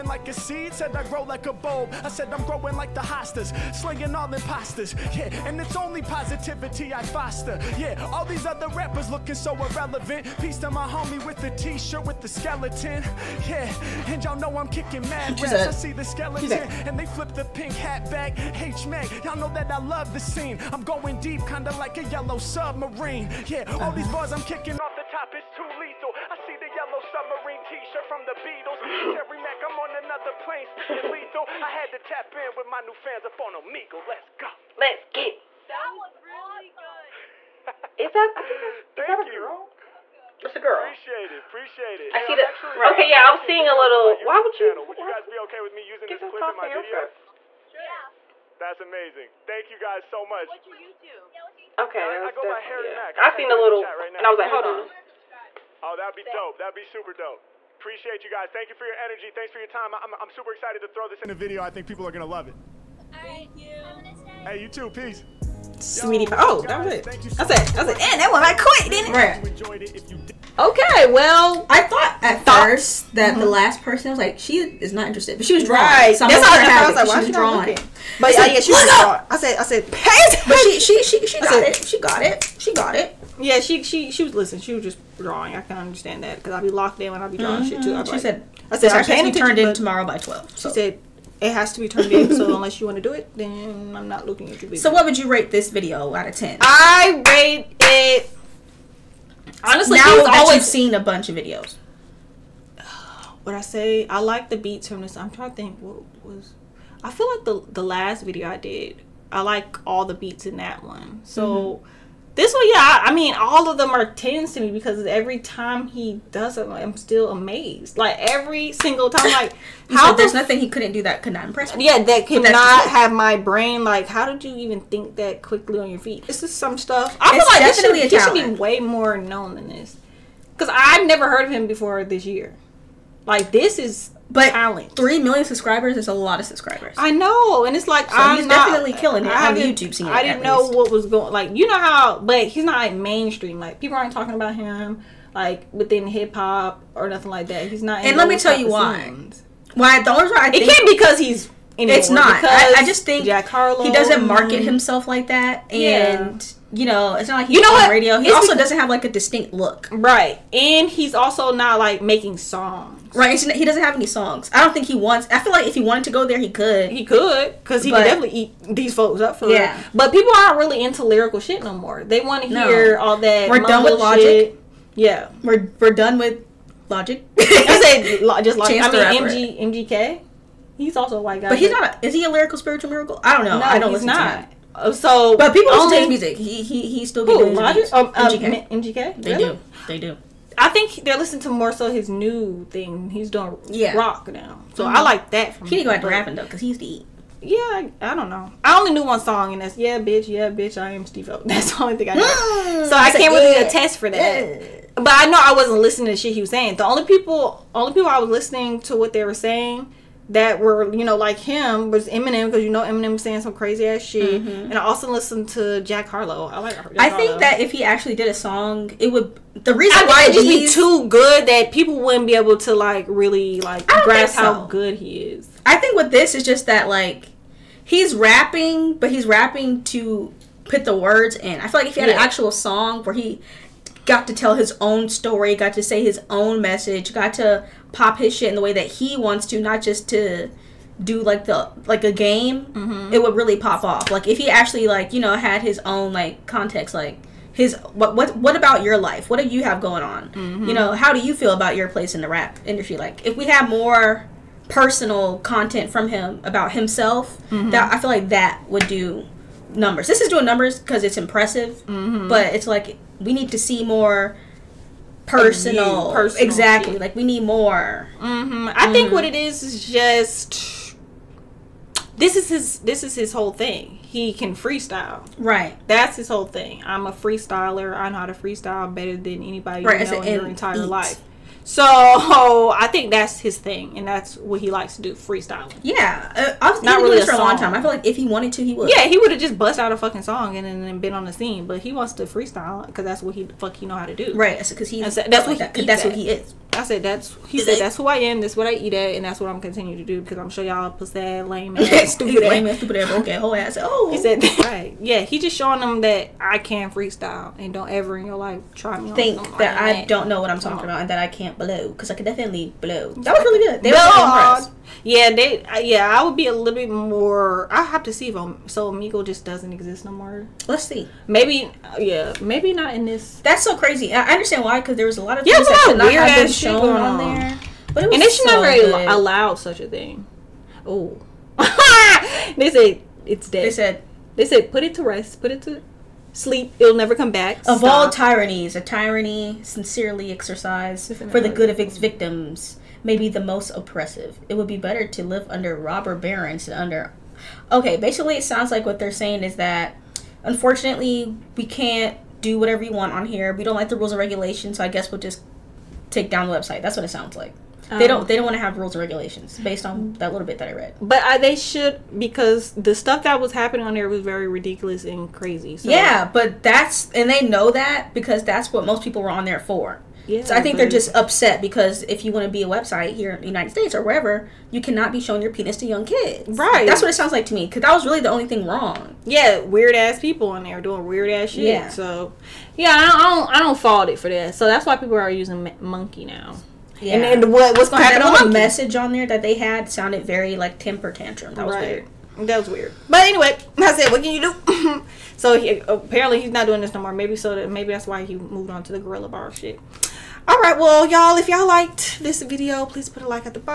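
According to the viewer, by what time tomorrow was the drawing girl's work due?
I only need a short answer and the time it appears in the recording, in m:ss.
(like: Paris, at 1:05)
12, at 1:30.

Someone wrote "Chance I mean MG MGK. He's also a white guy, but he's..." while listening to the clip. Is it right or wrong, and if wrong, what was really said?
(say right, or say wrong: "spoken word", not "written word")
right.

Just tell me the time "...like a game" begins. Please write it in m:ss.
4:01.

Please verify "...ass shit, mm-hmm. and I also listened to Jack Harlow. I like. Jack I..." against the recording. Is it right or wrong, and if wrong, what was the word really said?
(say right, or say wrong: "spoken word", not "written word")
right.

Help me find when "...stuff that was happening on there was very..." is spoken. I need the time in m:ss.
6:02.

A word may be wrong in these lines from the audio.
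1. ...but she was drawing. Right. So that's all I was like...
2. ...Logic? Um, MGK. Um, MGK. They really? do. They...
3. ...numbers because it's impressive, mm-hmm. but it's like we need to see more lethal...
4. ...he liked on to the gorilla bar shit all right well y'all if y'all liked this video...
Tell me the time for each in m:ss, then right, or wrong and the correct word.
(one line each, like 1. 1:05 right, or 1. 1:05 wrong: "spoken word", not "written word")
1. 1:15 right
2. 3:07 right
3. 4:20 wrong: "personal", not "lethal"
4. 6:38 wrong: "moved", not "liked".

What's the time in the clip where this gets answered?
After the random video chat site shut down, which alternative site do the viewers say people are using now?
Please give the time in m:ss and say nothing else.
6:25.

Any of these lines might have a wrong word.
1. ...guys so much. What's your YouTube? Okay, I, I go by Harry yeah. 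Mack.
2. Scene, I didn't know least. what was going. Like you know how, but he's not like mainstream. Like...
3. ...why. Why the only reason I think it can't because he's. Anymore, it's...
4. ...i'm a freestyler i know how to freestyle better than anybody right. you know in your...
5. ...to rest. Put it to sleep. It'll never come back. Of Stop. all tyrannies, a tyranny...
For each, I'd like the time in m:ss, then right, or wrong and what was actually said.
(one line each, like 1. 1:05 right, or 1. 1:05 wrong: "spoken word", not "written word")
1. 0:49 right
2. 2:19 right
3. 2:28 right
4. 4:36 right
5. 5:34 right.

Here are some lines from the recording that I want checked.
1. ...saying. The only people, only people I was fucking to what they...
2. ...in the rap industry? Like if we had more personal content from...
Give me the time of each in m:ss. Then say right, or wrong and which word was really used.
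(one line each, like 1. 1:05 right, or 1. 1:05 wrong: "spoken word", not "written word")
1. 3:26 wrong: "listening", not "fucking"
2. 4:12 right.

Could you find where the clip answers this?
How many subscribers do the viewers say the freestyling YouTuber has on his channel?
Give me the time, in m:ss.
2:14.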